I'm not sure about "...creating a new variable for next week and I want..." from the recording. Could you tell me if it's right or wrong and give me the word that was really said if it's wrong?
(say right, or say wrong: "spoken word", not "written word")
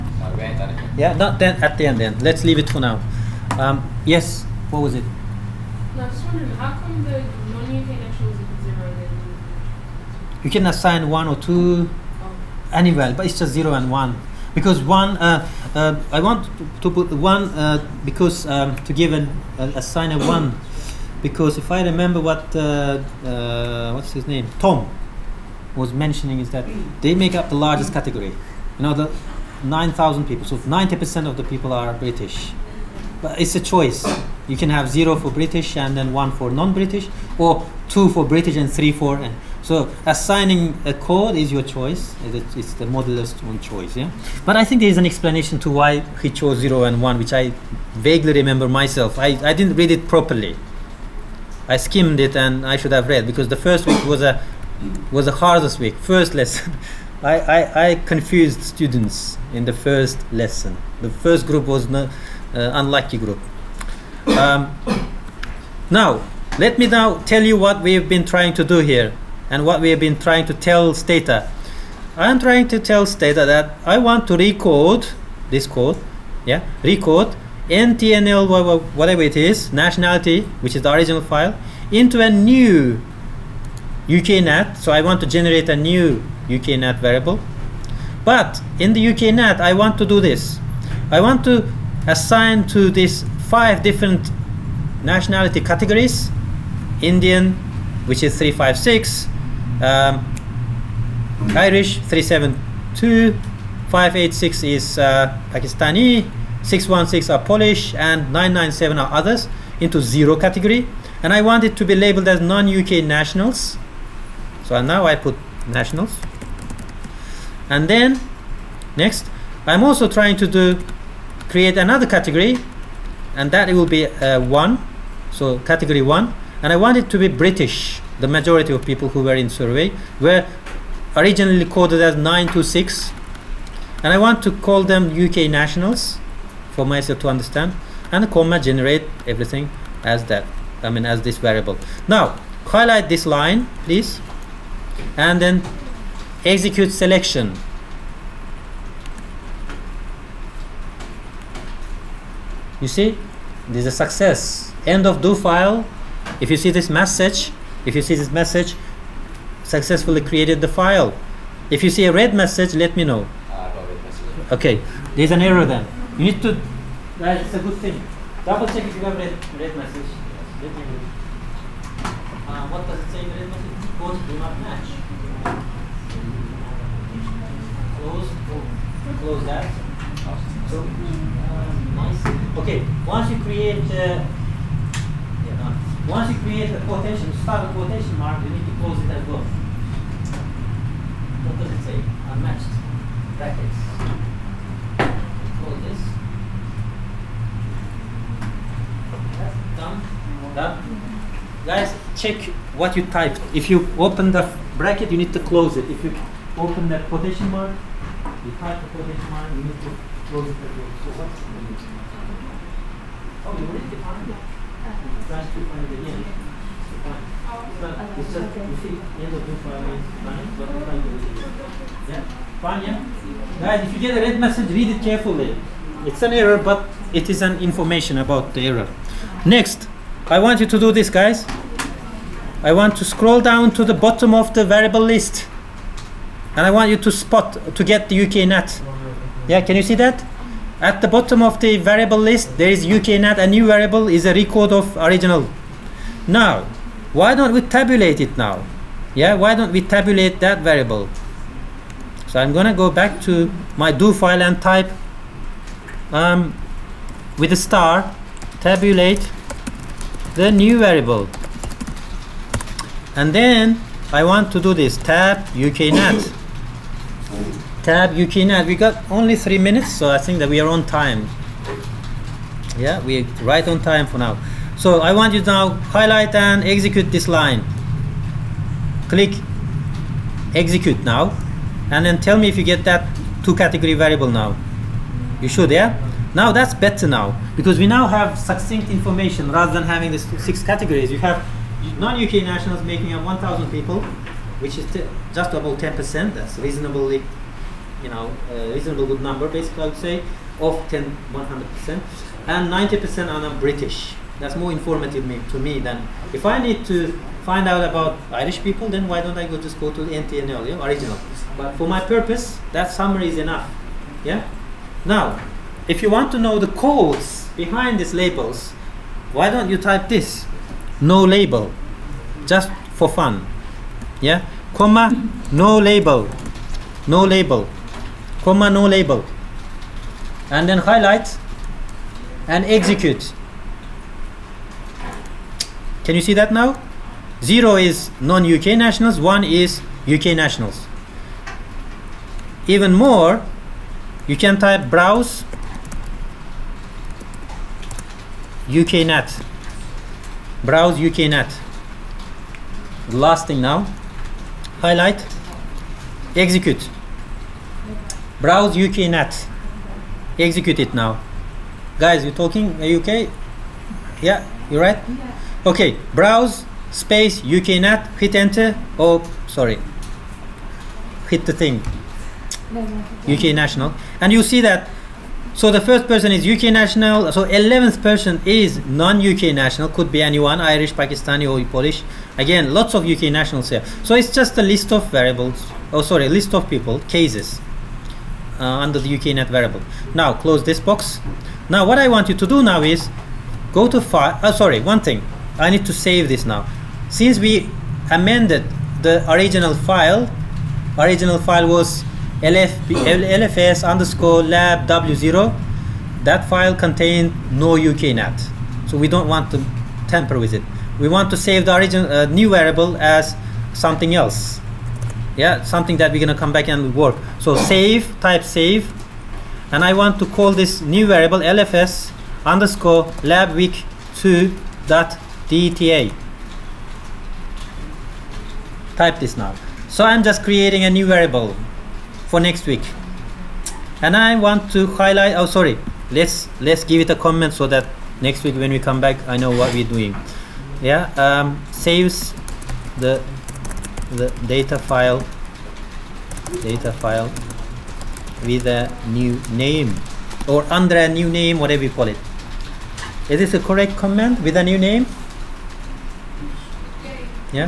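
right.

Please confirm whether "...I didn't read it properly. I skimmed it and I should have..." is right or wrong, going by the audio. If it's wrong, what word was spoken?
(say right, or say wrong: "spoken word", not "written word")
right.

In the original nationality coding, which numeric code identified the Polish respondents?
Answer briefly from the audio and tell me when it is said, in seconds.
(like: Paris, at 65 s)
616, at 106 s.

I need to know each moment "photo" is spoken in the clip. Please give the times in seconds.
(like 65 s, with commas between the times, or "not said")
not said.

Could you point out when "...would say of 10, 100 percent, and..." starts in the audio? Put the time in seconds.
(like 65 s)
299 s.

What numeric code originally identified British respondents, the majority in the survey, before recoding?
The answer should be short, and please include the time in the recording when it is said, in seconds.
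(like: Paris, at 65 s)
926, at 132 s.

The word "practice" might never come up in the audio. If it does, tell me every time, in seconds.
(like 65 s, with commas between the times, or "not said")
not said.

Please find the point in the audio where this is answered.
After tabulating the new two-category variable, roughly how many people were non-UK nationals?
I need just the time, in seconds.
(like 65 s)
293 s.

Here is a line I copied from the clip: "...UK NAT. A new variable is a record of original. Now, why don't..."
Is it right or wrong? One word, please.
right.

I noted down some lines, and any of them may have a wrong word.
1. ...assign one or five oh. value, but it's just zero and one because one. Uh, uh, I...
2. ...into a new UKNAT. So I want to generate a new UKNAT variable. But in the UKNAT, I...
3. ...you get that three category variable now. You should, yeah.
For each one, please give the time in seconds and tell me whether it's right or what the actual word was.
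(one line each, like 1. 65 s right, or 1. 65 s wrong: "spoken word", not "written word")
1. 10 s wrong: "two", not "five"
2. 81 s right
3. 282 s wrong: "two", not "three".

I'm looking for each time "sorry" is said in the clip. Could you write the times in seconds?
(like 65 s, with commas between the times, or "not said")
369 s, 386 s, 394 s, 435 s.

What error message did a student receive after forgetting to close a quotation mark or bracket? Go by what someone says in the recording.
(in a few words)
Unmatched brackets.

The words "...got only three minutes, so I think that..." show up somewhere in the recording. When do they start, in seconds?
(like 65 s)
268 s.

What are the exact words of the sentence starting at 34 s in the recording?
You can have zero for British and then one for non-British, or two for British and three for.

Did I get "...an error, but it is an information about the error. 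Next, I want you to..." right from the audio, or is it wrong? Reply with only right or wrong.
right.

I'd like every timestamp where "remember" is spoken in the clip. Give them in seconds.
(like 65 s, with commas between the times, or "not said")
21 s, 48 s.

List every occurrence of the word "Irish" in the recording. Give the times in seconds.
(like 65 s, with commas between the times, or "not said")
101 s, 308 s, 380 s.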